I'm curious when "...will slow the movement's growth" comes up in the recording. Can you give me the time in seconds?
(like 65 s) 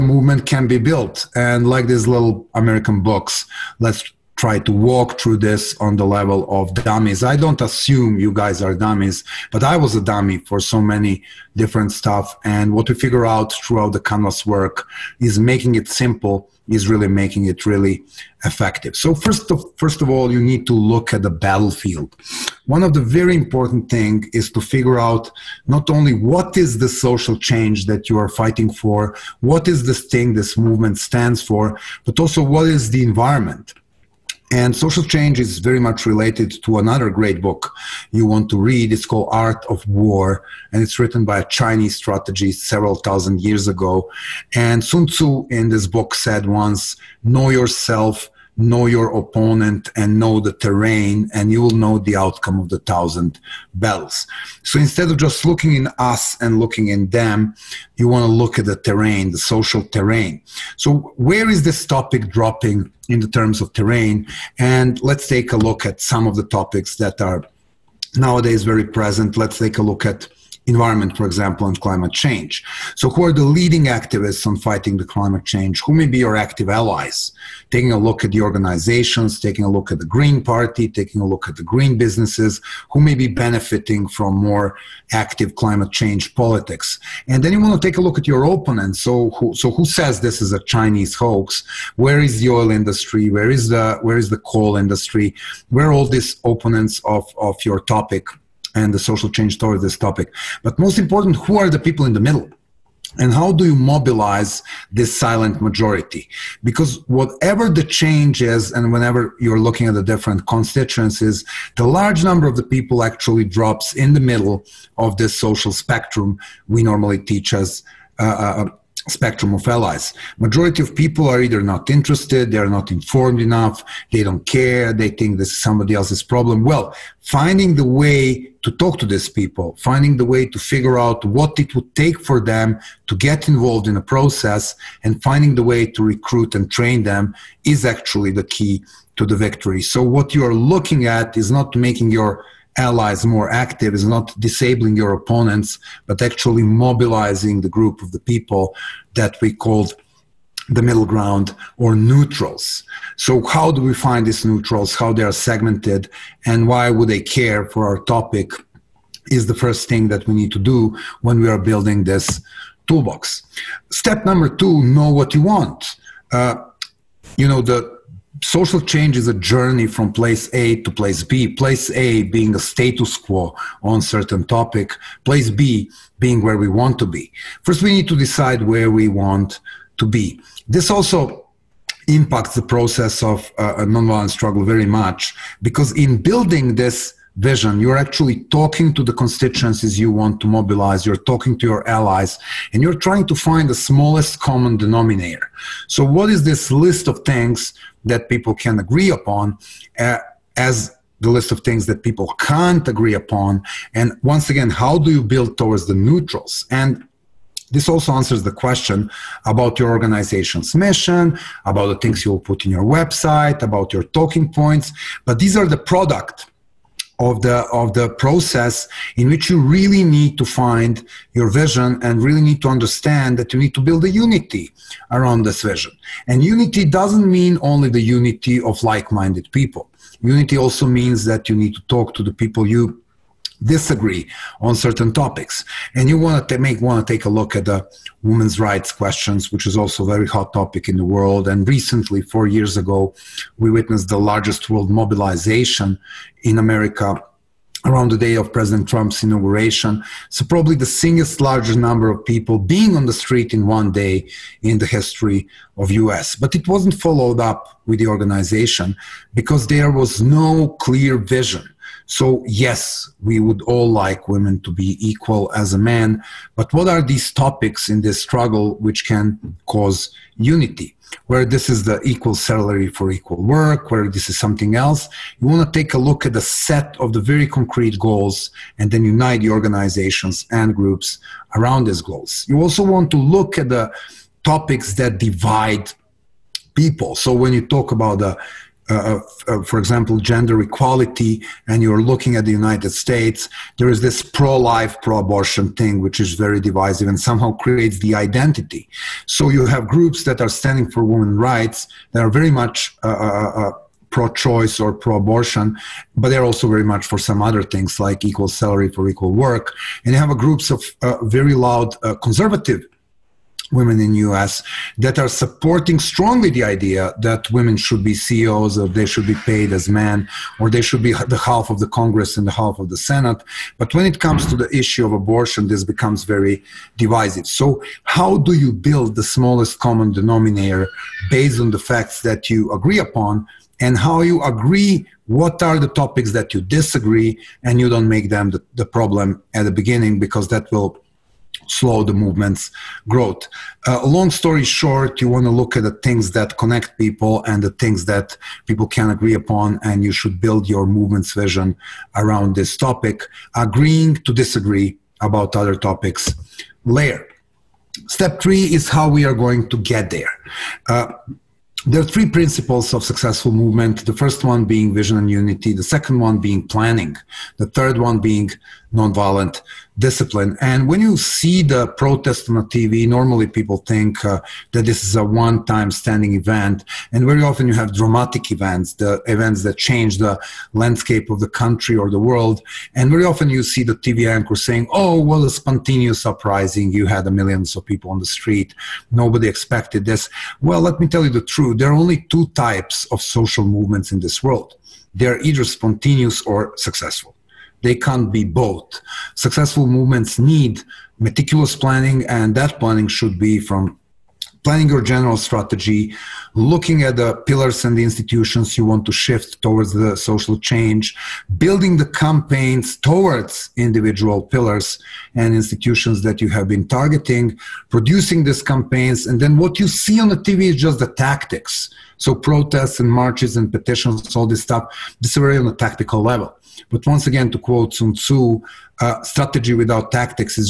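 340 s.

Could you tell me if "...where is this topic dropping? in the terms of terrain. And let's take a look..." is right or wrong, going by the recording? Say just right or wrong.
right.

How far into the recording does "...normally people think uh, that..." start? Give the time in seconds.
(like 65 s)
373 s.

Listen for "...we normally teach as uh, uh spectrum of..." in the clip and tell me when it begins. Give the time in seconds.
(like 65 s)
116 s.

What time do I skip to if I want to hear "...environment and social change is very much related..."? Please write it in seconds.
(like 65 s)
33 s.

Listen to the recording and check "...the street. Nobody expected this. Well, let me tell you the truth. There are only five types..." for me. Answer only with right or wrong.
wrong.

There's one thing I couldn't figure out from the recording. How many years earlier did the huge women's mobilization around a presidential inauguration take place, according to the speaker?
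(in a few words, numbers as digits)
4.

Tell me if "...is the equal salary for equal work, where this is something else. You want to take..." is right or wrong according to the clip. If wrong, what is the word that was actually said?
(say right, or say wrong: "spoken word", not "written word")
right.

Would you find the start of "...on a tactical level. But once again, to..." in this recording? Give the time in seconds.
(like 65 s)
425 s.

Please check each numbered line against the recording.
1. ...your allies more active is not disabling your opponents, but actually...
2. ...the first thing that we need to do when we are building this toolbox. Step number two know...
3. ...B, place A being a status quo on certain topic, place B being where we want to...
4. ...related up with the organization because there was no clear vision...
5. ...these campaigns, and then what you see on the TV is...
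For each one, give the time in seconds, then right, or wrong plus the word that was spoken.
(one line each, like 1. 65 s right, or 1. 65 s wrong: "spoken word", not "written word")
1. 142 s right
2. 159 s right
3. 171 s right
4. 256 s wrong: "followed", not "related"
5. 418 s right.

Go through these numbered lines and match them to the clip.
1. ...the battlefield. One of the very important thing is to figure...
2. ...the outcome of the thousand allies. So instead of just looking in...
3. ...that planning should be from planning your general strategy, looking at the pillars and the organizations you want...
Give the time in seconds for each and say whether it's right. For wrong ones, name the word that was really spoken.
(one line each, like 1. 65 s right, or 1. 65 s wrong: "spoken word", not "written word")
1. 21 s right
2. 51 s wrong: "battles", not "allies"
3. 402 s wrong: "institutions", not "organizations".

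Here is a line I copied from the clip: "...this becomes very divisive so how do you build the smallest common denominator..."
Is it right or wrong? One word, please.
right.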